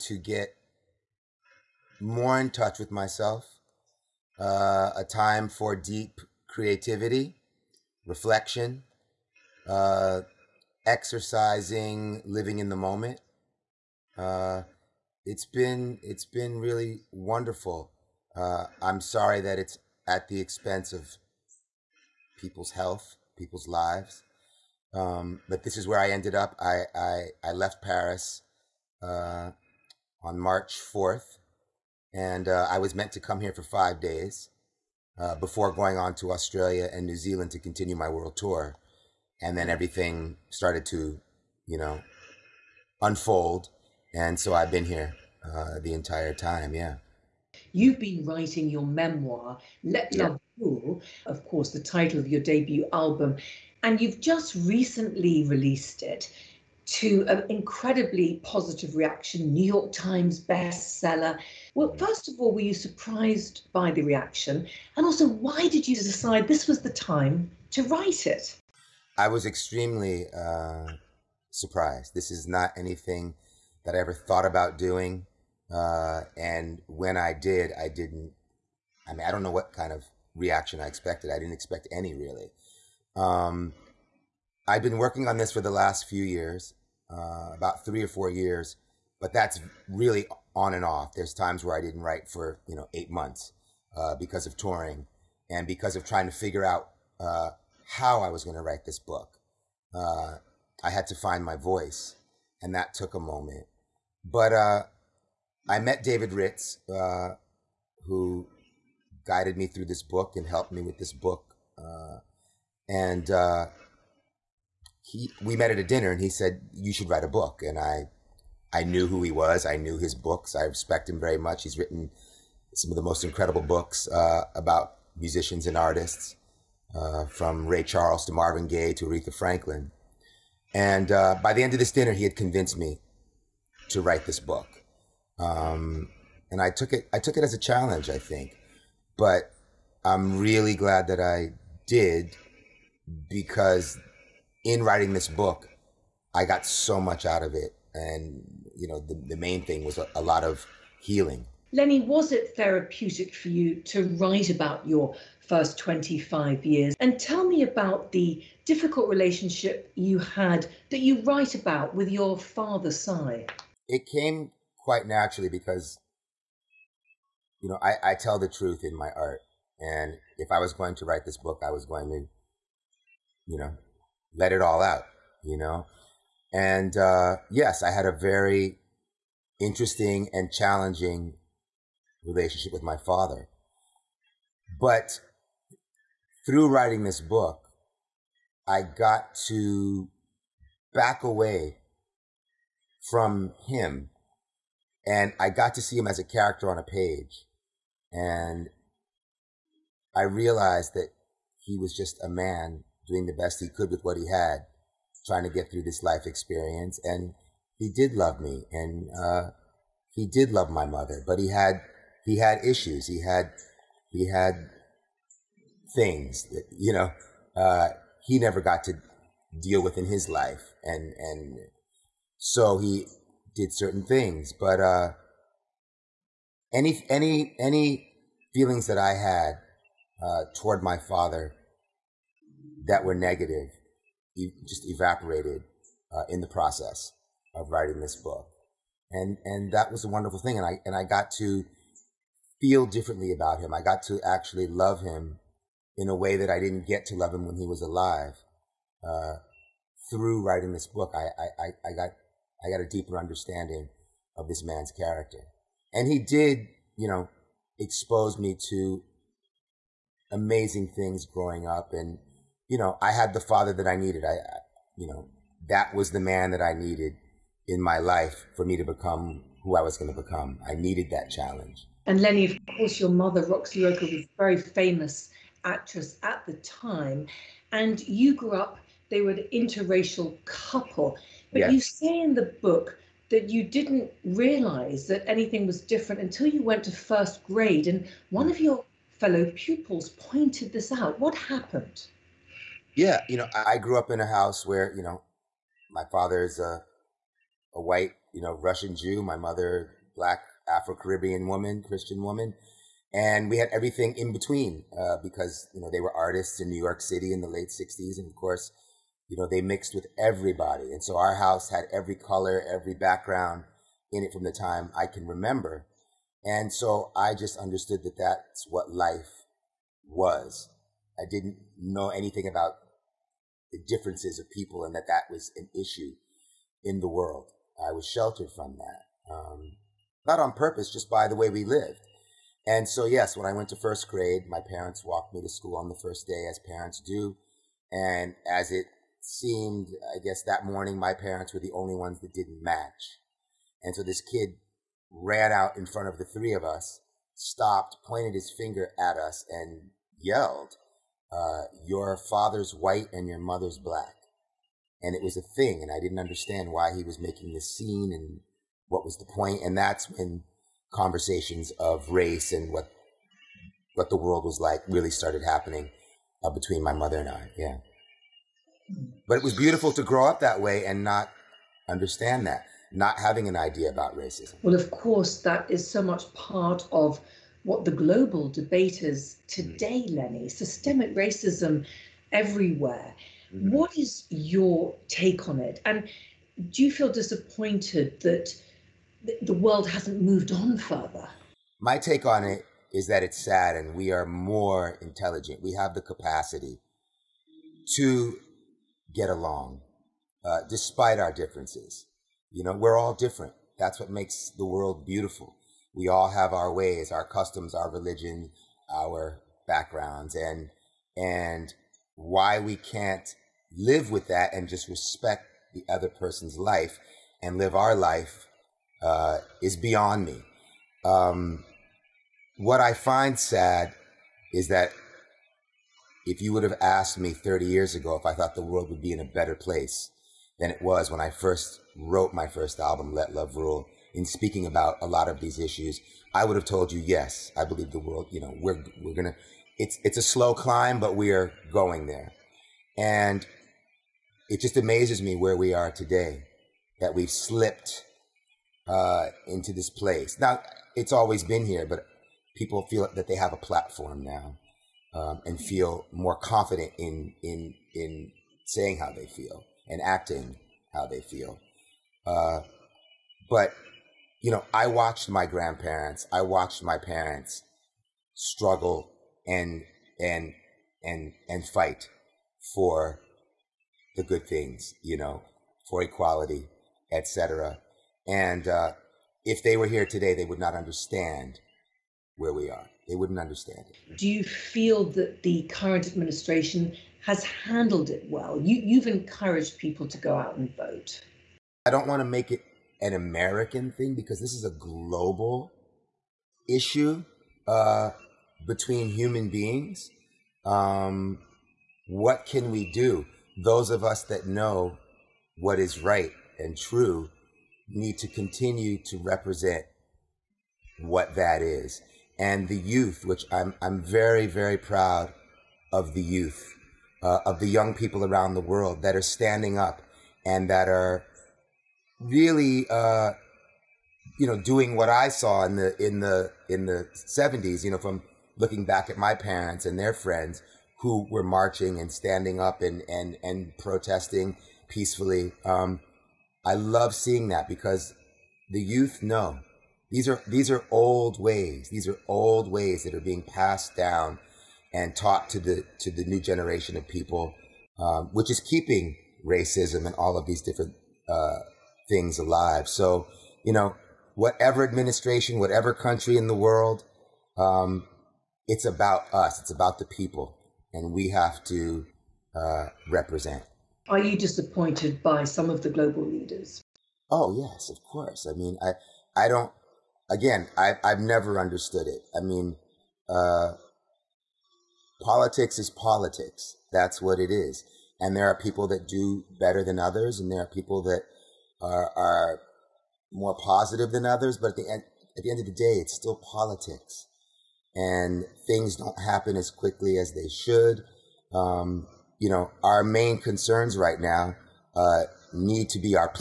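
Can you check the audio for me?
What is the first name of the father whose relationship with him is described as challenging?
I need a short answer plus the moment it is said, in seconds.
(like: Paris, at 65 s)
Sy, at 162 s.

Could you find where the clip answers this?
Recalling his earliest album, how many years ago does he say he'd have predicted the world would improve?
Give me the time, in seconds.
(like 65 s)
427 s.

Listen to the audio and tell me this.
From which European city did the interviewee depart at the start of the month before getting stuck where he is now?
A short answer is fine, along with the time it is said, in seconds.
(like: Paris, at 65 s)
Paris, at 27 s.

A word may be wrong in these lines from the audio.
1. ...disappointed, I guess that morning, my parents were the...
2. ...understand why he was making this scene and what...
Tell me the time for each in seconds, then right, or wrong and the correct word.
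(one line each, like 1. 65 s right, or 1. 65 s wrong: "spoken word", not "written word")
1. 339 s wrong: "seemed", not "disappointed"
2. 356 s right.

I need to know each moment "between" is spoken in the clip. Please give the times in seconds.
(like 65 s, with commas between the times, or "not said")
304 s, 366 s, 498 s.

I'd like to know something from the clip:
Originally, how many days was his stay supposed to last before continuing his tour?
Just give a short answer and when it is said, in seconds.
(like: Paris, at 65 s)
5, at 33 s.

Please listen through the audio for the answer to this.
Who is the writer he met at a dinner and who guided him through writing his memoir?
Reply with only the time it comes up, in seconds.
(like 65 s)
106 s.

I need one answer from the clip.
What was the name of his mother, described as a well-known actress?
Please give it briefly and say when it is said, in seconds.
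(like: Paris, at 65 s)
Roxie Roker, at 273 s.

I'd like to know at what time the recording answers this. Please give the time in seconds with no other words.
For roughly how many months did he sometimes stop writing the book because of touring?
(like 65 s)
92 s.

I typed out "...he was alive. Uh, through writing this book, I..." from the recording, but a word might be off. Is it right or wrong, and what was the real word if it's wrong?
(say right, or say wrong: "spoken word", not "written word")
right.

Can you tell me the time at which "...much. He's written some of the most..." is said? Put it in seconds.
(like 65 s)
121 s.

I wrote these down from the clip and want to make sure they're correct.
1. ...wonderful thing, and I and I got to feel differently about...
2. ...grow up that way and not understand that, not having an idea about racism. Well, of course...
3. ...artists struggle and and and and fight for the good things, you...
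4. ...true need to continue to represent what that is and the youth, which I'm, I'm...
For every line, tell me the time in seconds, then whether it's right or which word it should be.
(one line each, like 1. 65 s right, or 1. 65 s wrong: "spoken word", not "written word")
1. 240 s right
2. 370 s right
3. 466 s wrong: "parents", not "artists"
4. 506 s right.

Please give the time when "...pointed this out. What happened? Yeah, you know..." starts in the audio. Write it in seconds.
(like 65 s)
290 s.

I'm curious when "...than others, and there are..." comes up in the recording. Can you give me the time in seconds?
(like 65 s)
579 s.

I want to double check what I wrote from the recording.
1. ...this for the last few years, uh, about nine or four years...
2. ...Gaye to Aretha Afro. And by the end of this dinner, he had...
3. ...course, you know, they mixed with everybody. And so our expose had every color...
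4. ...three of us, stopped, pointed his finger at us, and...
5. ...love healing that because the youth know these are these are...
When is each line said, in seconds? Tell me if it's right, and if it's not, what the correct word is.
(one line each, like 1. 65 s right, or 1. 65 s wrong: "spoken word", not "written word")
1. 85 s wrong: "three", not "nine"
2. 128 s wrong: "Franklin", not "Afro"
3. 308 s wrong: "house", not "expose"
4. 346 s right
5. 536 s wrong: "seeing", not "healing".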